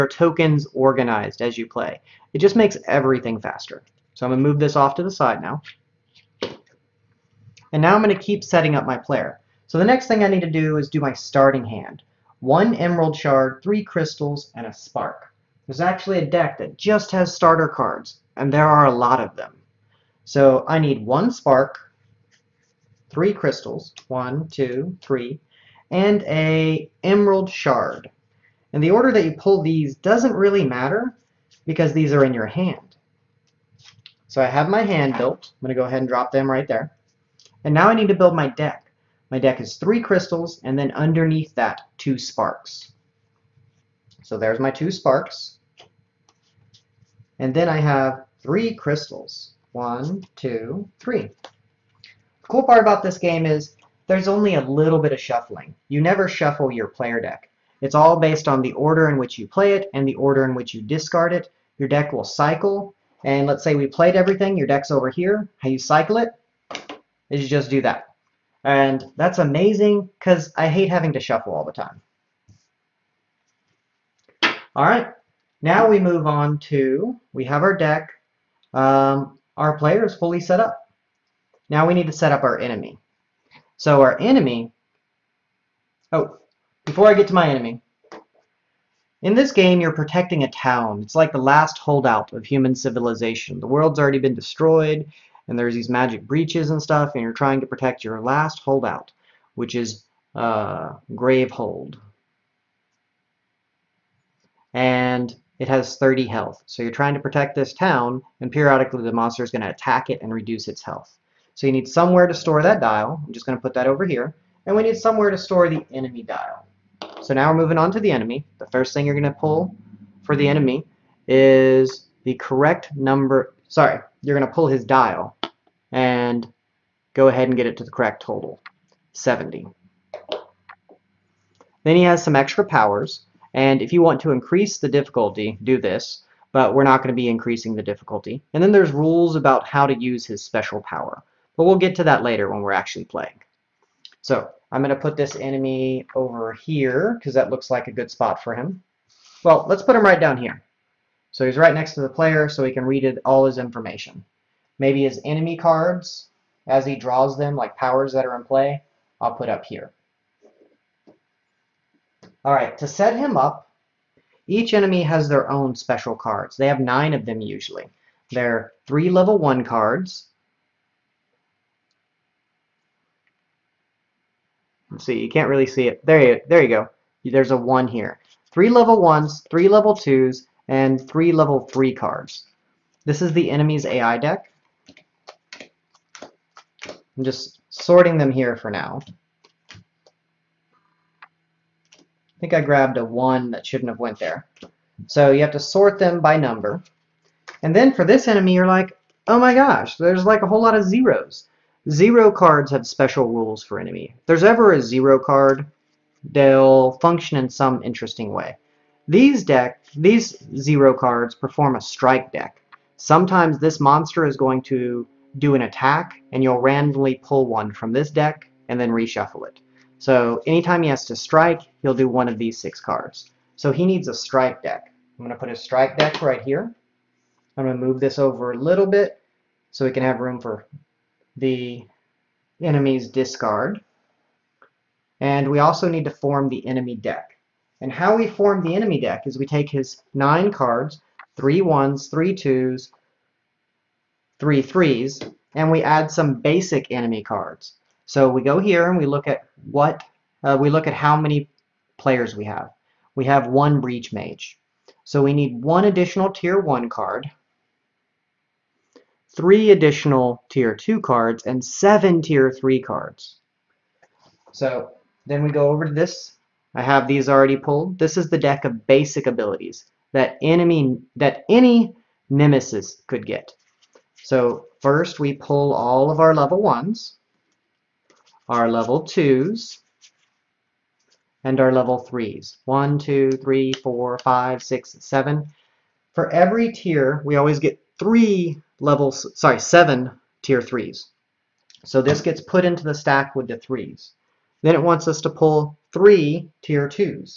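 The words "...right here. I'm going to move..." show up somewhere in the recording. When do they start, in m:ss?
3:46.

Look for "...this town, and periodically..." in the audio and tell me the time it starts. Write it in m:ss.
1:47.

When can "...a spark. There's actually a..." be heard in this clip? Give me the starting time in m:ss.
0:14.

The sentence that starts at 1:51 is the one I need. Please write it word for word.
So you need somewhere to store that dial.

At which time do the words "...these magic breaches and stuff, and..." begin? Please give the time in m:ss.
1:35.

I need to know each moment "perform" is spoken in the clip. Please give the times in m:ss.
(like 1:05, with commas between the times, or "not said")
3:31.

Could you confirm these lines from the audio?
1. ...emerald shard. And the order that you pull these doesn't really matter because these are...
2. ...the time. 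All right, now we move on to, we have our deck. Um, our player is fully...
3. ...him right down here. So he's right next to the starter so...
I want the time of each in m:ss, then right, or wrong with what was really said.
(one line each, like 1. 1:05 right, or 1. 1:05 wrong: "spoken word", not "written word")
1. 0:27 right
2. 1:11 right
3. 2:29 wrong: "player", not "starter".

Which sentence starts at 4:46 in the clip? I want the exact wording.
For every tier, we always get three levels, sorry, seven tier threes.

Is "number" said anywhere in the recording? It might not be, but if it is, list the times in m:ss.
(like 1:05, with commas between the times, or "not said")
2:02, 3:16.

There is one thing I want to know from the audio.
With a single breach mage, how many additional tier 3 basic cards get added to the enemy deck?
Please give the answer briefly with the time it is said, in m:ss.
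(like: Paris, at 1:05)
7, at 4:21.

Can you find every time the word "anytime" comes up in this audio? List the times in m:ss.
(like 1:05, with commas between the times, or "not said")
3:40.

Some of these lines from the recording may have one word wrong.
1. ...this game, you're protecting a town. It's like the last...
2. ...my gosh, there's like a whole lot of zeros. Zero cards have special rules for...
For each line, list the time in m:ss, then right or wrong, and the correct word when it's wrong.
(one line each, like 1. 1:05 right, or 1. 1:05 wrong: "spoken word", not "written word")
1. 1:29 right
2. 3:19 right.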